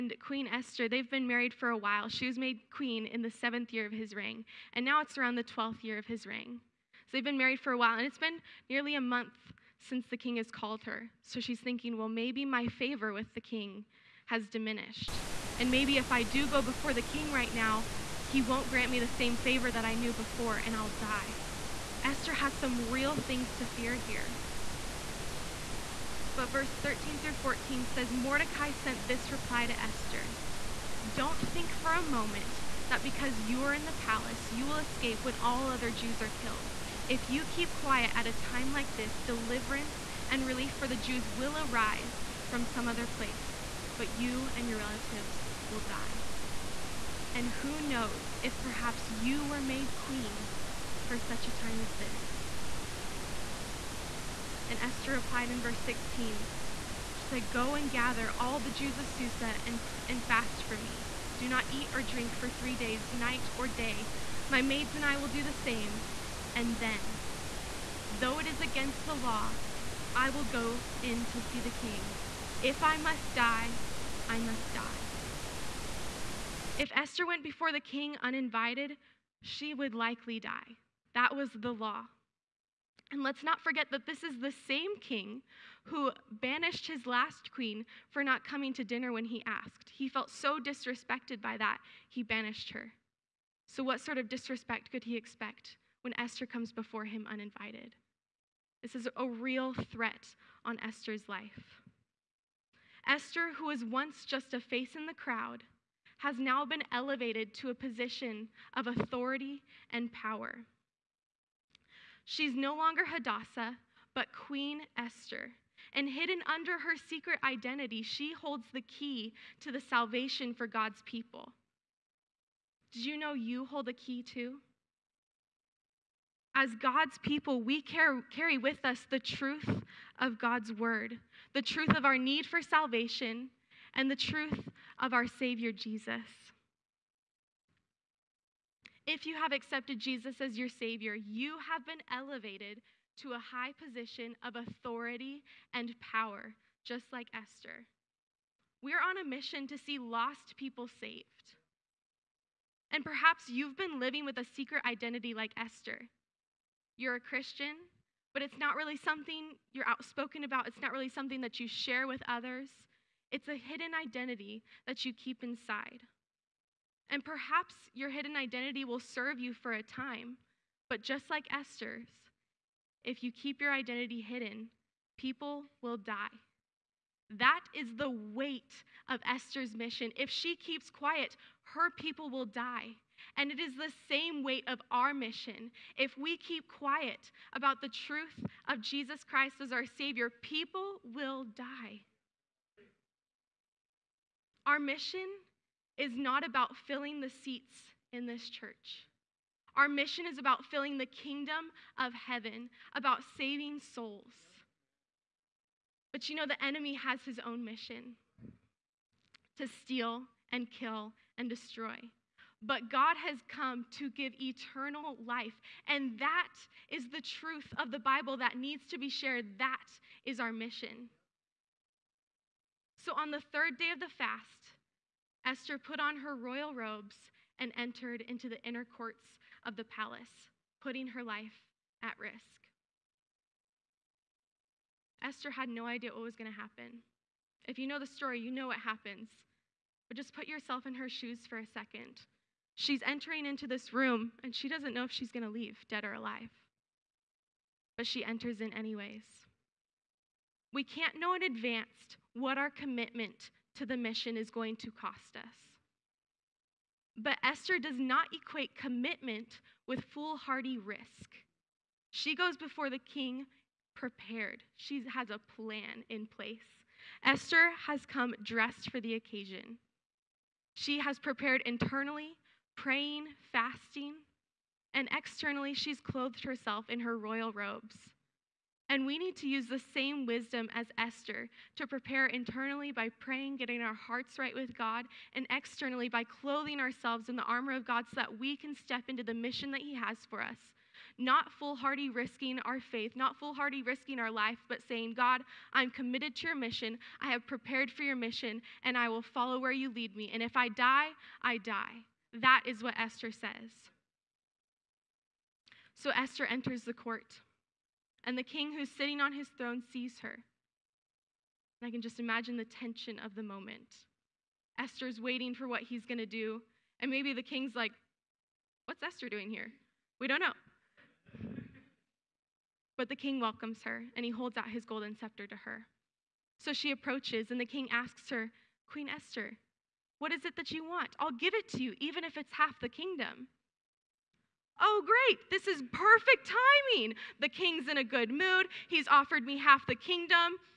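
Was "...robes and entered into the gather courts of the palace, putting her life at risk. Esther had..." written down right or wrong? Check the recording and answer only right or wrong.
wrong.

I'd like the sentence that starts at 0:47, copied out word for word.
And who knows if perhaps you were made queen for such a time as this?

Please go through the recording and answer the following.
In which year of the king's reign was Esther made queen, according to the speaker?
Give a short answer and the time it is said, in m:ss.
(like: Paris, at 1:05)
7th, at 0:03.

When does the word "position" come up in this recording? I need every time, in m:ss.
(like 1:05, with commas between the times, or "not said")
1:47, 2:23.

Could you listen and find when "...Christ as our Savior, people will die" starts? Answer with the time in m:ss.
3:09.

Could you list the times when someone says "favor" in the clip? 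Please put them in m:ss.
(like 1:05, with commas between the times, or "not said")
0:12, 0:19.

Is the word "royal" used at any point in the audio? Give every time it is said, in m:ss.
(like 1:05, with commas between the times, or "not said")
3:46, 4:37.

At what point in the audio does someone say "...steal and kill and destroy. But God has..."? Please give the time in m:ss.
3:29.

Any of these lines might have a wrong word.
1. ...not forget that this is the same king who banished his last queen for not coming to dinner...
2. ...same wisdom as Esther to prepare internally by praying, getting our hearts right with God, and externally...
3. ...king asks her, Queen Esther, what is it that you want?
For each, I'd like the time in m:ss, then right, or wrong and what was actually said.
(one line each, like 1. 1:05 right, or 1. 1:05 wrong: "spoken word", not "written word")
1. 1:23 right
2. 4:39 right
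3. 5:27 right.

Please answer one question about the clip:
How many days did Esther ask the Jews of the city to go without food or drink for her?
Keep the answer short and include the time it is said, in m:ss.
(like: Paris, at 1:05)
3, at 1:02.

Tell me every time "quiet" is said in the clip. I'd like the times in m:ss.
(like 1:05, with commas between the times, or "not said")
0:37, 3:00, 3:06.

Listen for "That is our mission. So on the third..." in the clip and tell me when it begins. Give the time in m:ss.
3:39.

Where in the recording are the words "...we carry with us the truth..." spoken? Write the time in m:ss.
2:07.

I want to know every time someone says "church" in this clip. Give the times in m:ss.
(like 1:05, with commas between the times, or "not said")
3:18.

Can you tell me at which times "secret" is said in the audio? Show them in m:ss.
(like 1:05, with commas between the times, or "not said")
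1:57, 2:34.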